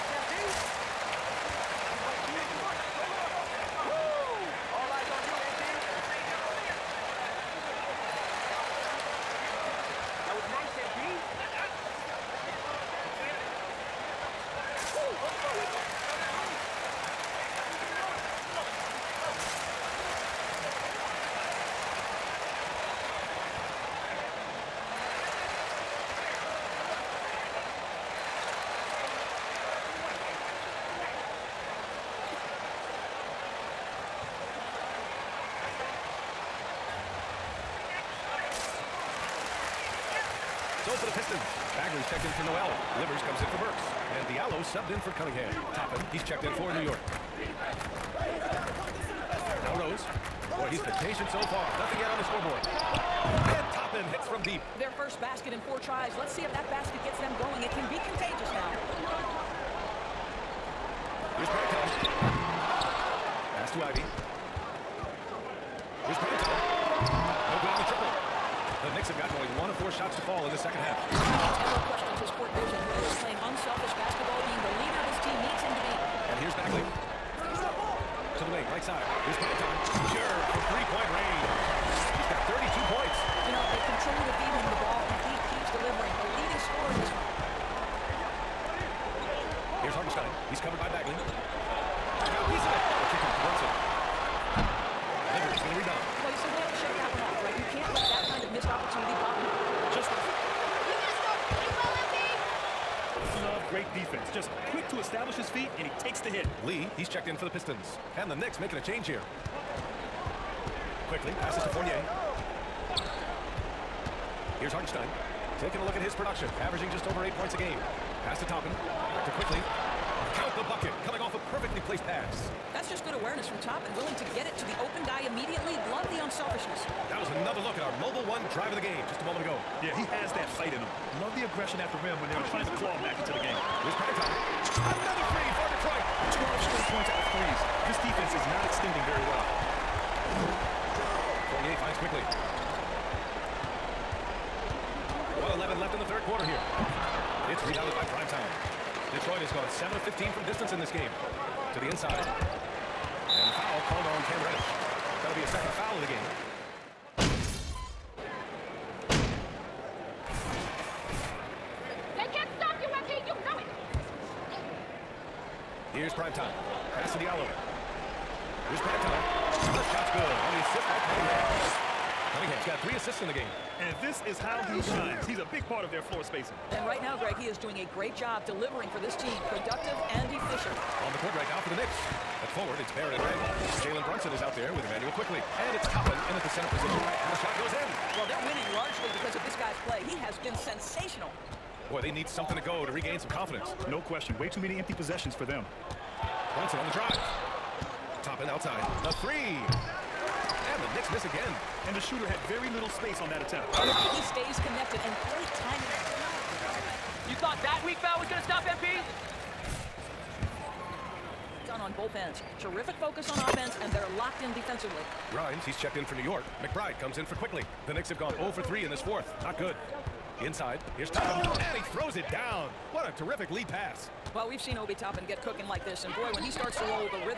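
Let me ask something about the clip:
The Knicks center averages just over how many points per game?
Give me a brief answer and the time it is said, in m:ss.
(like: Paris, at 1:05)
8, at 1:57.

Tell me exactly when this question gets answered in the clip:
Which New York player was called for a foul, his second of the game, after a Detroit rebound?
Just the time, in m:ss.
2:34.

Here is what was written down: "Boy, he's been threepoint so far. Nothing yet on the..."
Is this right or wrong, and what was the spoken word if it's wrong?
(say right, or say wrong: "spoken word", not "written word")
wrong: "patient", not "threepoint".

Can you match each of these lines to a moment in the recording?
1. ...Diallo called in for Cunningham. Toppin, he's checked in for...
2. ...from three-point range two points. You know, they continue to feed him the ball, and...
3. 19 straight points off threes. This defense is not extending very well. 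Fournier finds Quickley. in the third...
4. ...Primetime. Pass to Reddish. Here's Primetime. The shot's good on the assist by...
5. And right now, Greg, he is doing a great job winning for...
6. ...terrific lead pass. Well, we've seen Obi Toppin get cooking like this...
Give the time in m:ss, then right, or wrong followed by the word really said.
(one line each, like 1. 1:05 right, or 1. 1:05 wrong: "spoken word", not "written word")
1. 0:44 wrong: "subbed", not "called"
2. 1:20 right
3. 2:16 wrong: "12", not "19"
4. 2:46 wrong: "Diallo", not "Reddish"
5. 2:56 wrong: "delivering", not "winning"
6. 3:43 right.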